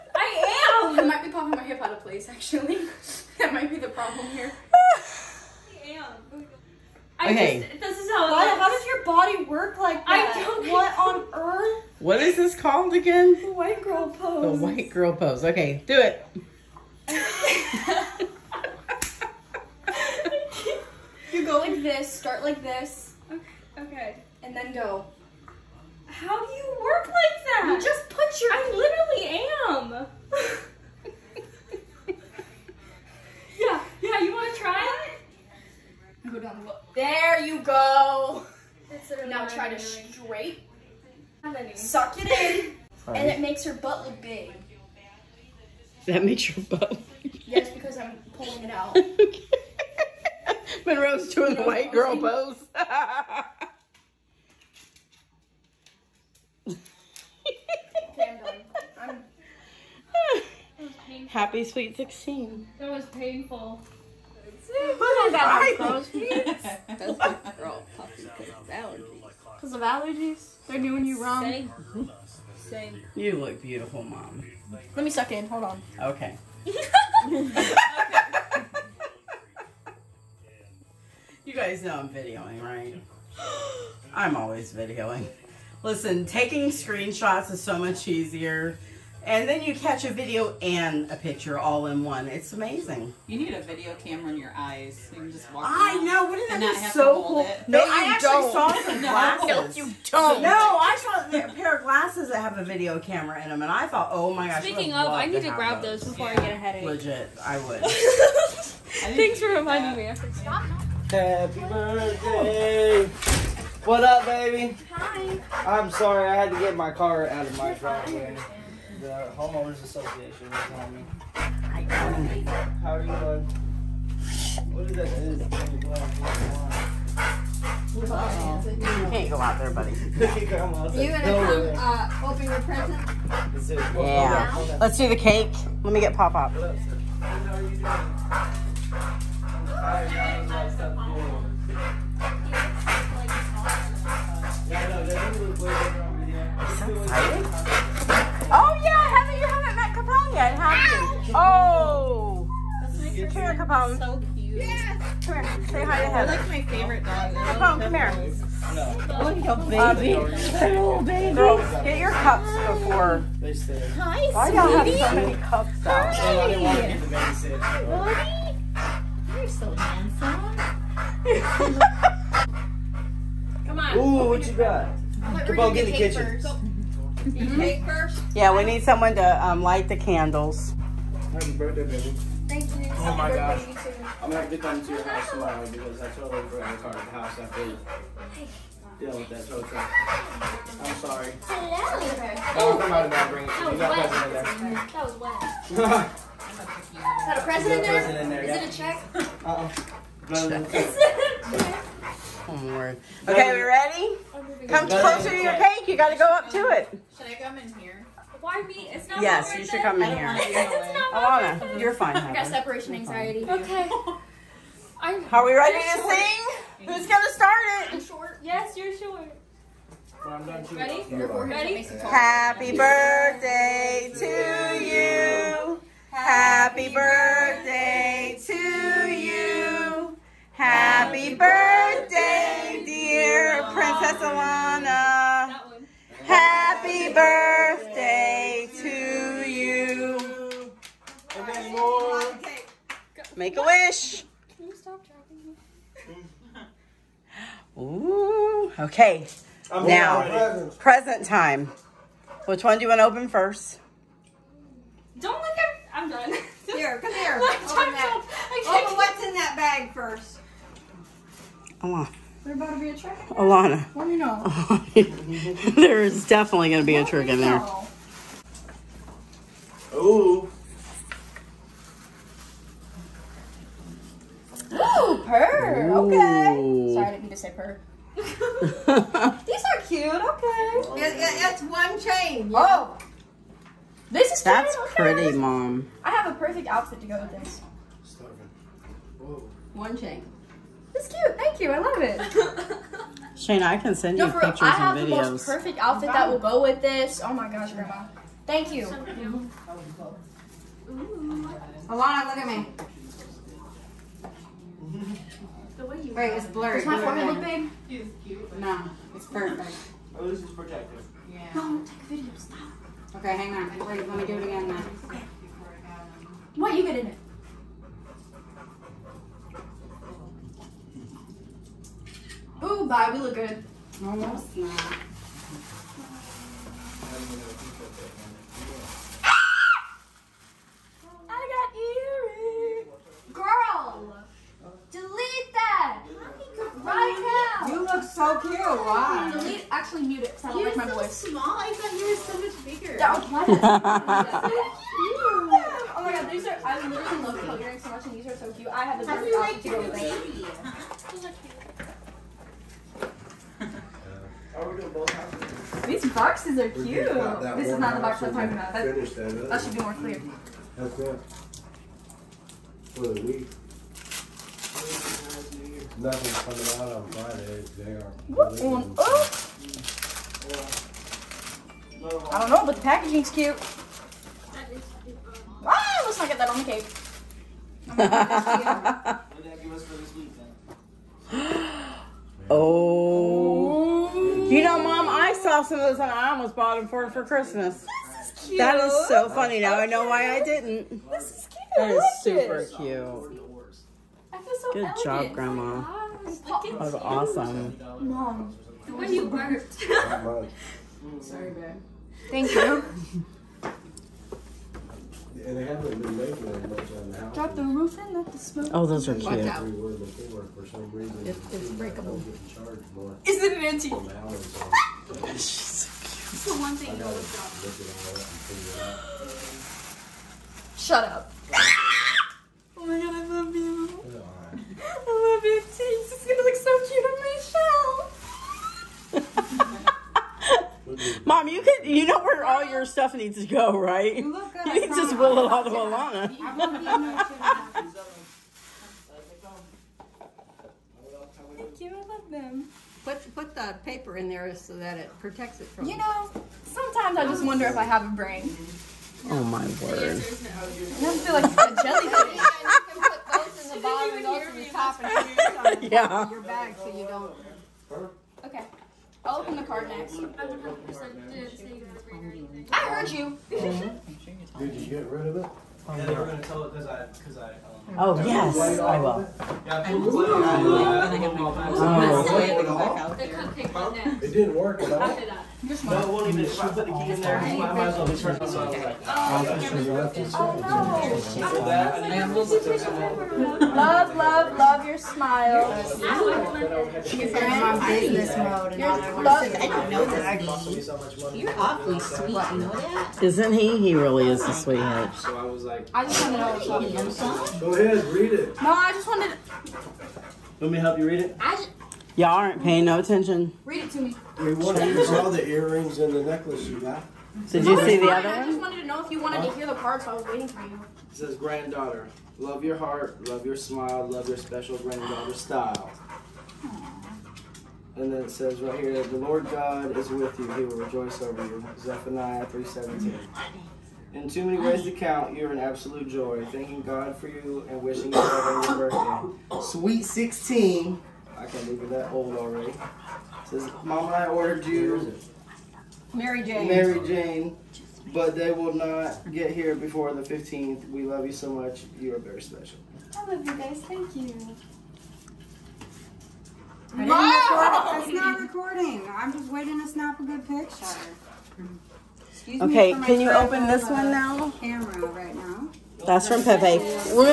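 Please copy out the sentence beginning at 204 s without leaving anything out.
Oh, come closer to your cake.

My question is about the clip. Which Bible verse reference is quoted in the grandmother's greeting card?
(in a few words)
Zephaniah 3:17.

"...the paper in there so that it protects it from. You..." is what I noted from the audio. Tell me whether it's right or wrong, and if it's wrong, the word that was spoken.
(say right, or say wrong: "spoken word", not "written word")
right.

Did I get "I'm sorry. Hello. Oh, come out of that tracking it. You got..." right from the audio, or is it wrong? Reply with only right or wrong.
wrong.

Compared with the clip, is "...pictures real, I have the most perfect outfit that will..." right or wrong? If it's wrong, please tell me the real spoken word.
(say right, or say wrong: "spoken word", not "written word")
right.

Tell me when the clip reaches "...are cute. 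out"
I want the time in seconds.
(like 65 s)
409 s.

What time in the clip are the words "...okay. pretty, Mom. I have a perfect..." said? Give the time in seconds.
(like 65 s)
284 s.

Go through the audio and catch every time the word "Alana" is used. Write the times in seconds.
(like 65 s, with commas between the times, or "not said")
211 s, 234 s, 263 s, 301 s, 435 s.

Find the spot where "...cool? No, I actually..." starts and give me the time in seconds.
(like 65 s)
97 s.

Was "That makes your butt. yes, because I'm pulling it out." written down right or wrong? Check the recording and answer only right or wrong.
right.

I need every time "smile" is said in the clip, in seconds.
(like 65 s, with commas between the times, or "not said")
484 s, 513 s.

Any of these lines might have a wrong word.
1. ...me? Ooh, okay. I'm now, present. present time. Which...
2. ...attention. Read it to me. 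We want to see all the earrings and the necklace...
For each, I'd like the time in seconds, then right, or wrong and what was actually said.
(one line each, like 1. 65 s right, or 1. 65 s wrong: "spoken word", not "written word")
1. 246 s right
2. 502 s right.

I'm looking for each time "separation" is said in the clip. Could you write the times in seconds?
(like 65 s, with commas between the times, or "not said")
212 s.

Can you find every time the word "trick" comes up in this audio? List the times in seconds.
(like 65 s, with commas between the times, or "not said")
262 s, 267 s.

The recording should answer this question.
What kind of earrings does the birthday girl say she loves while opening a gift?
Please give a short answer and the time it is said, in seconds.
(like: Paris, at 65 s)
Coat earrings, at 347 s.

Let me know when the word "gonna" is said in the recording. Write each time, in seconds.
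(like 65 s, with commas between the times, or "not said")
131 s, 184 s, 217 s, 426 s, 466 s.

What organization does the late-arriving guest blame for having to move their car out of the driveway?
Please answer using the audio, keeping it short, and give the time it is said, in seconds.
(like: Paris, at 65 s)
Homeowners association, at 119 s.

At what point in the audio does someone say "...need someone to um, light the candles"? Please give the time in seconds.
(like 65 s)
178 s.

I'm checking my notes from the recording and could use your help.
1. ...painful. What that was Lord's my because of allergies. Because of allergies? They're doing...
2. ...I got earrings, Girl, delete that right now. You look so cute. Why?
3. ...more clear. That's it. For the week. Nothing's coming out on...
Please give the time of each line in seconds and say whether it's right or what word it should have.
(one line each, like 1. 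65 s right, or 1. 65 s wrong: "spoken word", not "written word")
1. 63 s wrong: "That", not "Lord"
2. 331 s right
3. 359 s right.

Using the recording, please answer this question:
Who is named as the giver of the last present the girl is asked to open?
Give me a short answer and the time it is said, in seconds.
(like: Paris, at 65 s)
Pepe, at 556 s.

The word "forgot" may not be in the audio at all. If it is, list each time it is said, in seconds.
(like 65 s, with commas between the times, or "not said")
186 s.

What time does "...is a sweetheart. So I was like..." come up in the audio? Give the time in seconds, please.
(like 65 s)
494 s.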